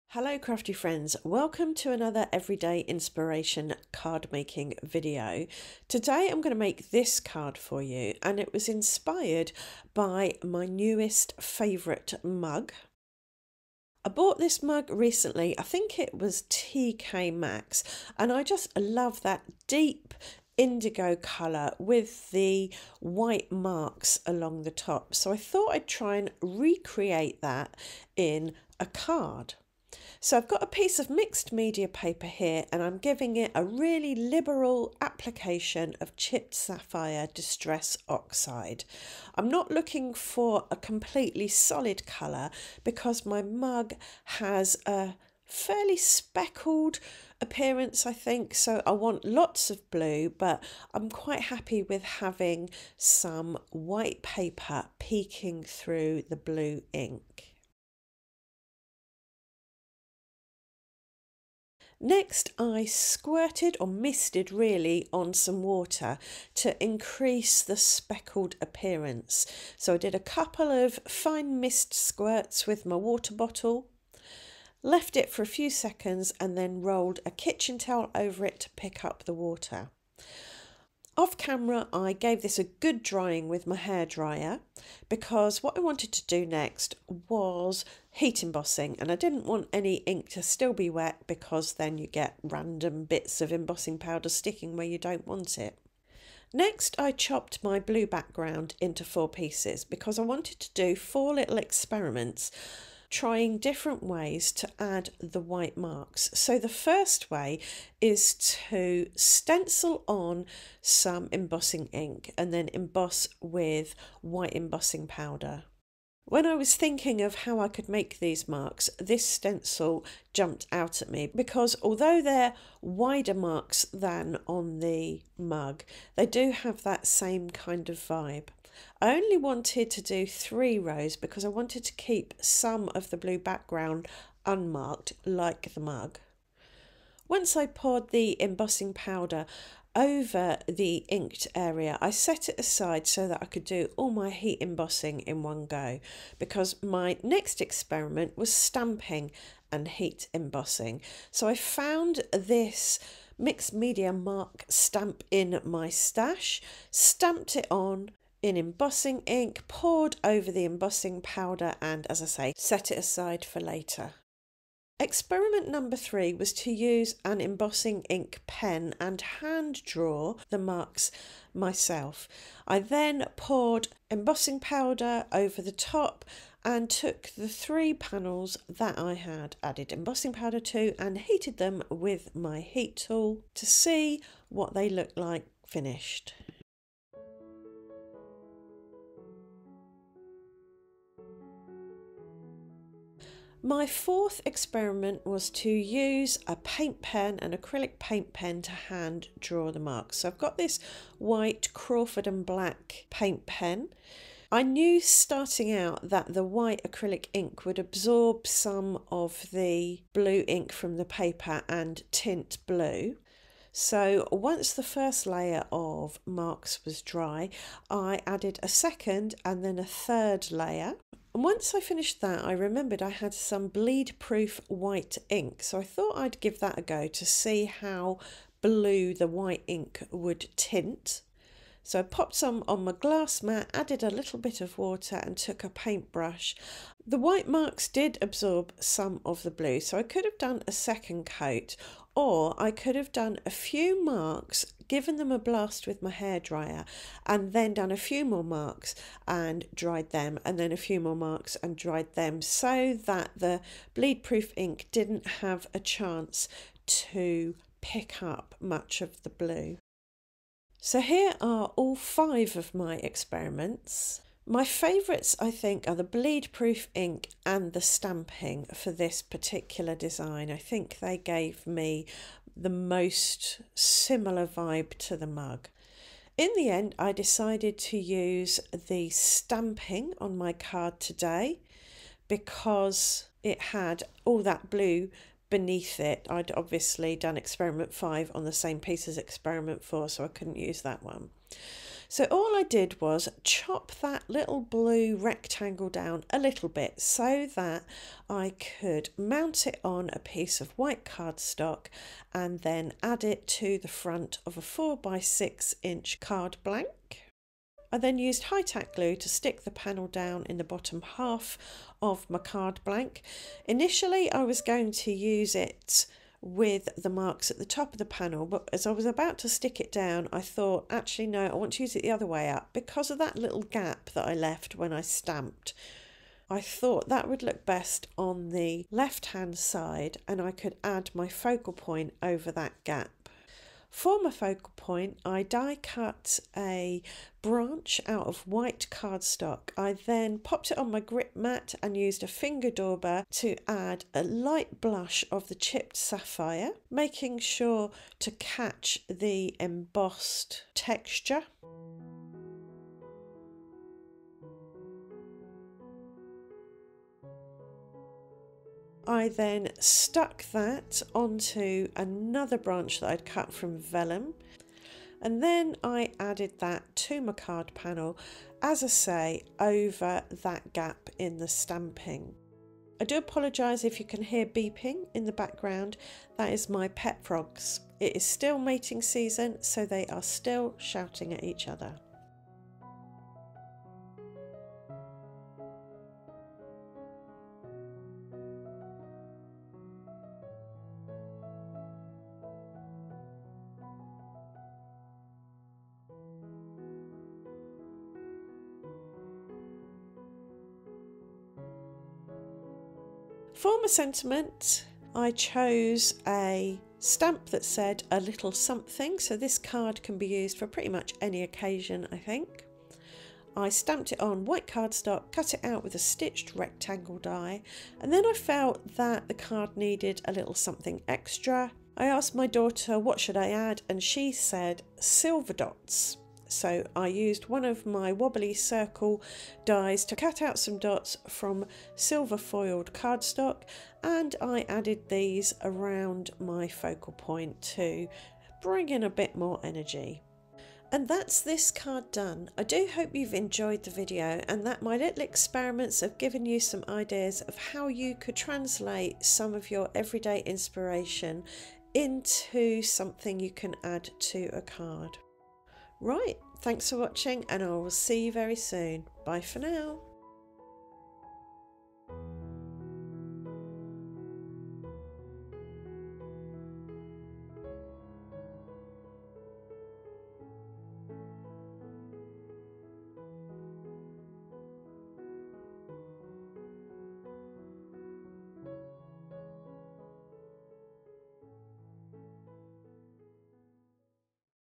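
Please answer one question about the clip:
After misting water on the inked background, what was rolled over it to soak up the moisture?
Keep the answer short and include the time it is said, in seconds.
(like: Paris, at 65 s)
Kitchen towel, at 77 s.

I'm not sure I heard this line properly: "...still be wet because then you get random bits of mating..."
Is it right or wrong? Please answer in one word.
wrong.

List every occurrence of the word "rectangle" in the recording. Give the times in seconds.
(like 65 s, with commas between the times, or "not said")
295 s, 416 s.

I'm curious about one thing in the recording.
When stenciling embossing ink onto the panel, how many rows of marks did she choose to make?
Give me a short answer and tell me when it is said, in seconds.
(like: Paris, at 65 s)
3, at 130 s.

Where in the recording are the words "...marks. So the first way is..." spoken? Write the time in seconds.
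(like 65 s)
105 s.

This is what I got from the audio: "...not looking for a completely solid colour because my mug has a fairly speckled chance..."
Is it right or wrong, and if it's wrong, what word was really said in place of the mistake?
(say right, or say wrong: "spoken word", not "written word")
wrong: "appearance", not "chance".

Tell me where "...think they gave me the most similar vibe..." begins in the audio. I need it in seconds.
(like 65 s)
270 s.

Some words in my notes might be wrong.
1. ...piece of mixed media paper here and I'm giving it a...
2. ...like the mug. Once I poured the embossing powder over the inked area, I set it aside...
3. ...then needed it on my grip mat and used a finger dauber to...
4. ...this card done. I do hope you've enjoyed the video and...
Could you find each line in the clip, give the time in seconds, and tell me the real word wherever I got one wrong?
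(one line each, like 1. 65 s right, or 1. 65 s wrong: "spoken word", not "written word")
1. 30 s right
2. 135 s right
3. 339 s wrong: "popped", not "needed"
4. 441 s right.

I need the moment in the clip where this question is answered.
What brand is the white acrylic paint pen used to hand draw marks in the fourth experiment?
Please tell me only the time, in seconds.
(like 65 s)
201 s.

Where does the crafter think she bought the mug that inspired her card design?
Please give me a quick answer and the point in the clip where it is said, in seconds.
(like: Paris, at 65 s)
TK Maxx, at 16 s.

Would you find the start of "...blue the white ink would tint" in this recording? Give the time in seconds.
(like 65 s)
228 s.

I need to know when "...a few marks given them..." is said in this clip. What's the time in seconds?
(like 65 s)
243 s.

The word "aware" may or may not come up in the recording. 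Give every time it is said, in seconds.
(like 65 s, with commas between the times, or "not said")
not said.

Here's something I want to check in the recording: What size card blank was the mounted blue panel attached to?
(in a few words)
4 by 6 inch.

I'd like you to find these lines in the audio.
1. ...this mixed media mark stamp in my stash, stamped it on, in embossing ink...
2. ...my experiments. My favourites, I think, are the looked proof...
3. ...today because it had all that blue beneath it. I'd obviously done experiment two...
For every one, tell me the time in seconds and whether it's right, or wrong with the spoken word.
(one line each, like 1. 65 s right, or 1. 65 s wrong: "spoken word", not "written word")
1. 152 s right
2. 262 s wrong: "bleed", not "looked"
3. 280 s wrong: "five", not "two".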